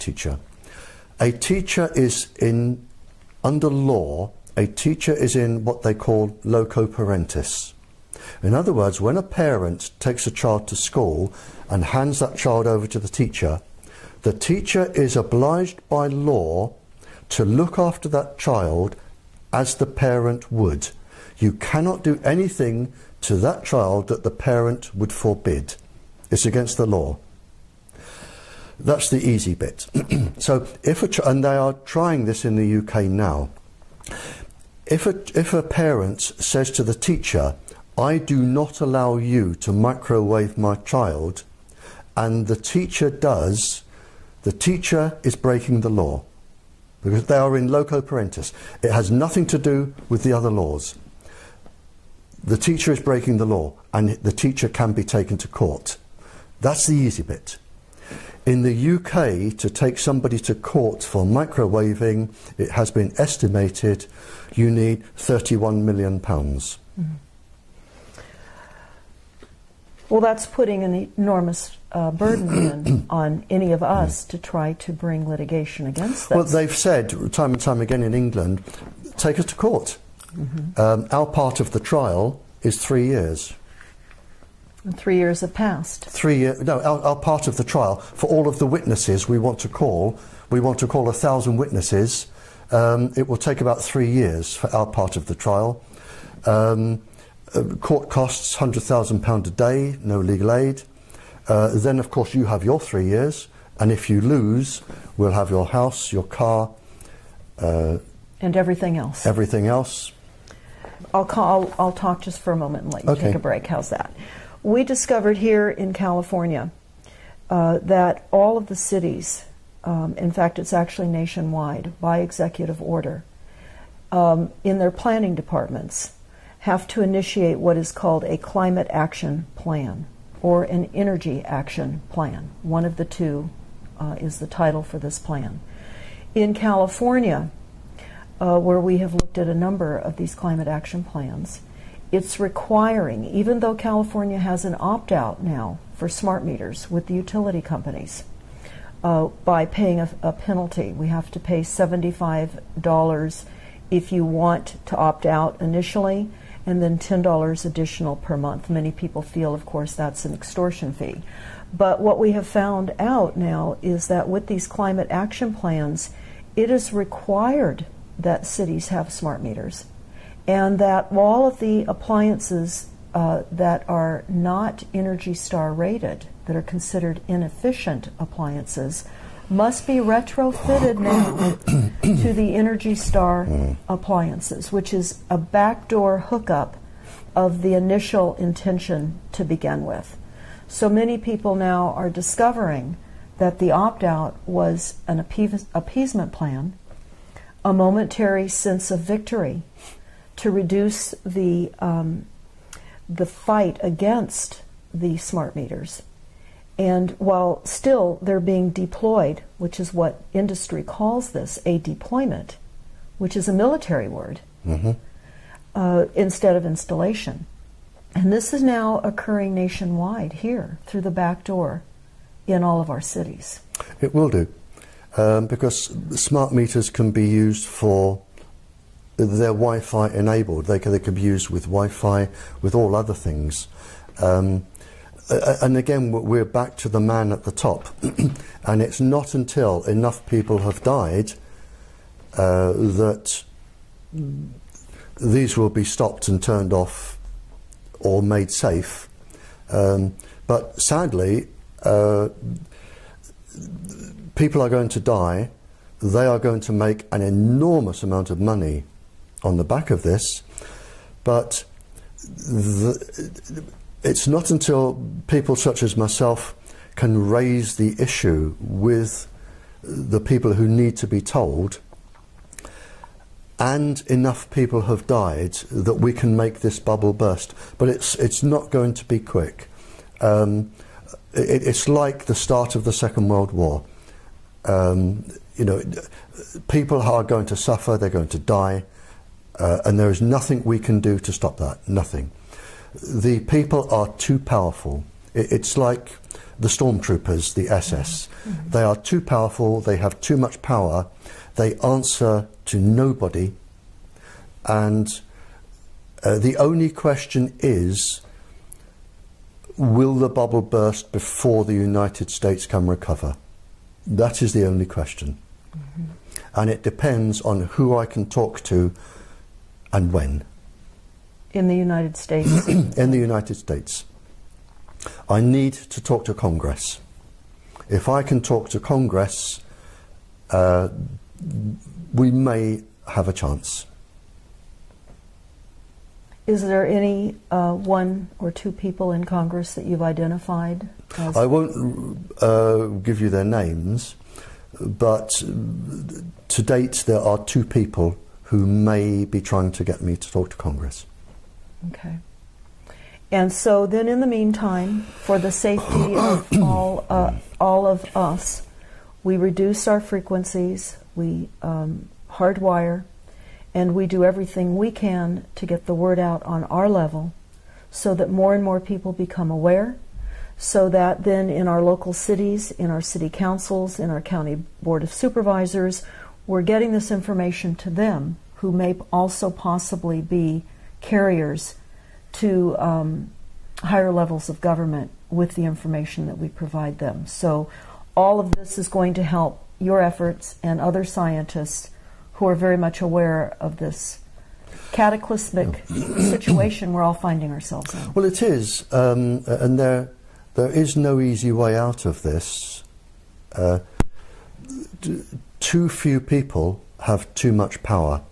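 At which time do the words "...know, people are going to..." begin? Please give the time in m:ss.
4:45.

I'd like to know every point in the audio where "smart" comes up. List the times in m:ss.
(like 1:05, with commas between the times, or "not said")
2:26, 2:49, 3:25, 3:46.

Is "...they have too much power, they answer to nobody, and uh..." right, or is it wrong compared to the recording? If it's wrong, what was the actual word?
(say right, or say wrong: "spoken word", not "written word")
right.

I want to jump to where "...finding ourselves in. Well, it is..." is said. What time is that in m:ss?
6:37.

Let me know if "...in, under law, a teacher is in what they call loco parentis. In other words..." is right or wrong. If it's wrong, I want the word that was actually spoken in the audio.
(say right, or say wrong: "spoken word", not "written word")
right.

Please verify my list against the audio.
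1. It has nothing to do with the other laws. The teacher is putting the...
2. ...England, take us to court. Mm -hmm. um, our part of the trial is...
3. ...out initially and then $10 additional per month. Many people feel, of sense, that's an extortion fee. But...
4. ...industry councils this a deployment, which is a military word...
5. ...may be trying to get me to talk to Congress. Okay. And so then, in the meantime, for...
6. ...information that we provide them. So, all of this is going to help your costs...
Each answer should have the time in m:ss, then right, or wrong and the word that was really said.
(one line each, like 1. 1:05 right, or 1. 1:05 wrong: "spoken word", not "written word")
1. 0:48 wrong: "breaking", not "putting"
2. 1:18 right
3. 2:35 wrong: "course", not "sense"
4. 3:30 wrong: "calls", not "councils"
5. 5:48 right
6. 6:25 wrong: "efforts", not "costs".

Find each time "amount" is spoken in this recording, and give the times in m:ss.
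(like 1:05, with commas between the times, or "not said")
4:18.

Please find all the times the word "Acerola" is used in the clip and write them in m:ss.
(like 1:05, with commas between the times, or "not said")
not said.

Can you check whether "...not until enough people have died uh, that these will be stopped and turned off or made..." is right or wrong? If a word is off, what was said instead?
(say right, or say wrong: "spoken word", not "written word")
right.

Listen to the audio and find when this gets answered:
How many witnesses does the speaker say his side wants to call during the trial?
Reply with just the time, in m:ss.
1:31.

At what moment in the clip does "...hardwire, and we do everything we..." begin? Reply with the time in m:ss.
6:02.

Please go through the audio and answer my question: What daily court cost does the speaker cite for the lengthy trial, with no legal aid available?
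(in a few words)
£100,000.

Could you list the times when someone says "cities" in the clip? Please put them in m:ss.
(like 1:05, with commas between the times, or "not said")
1:58, 2:48, 3:43, 6:12.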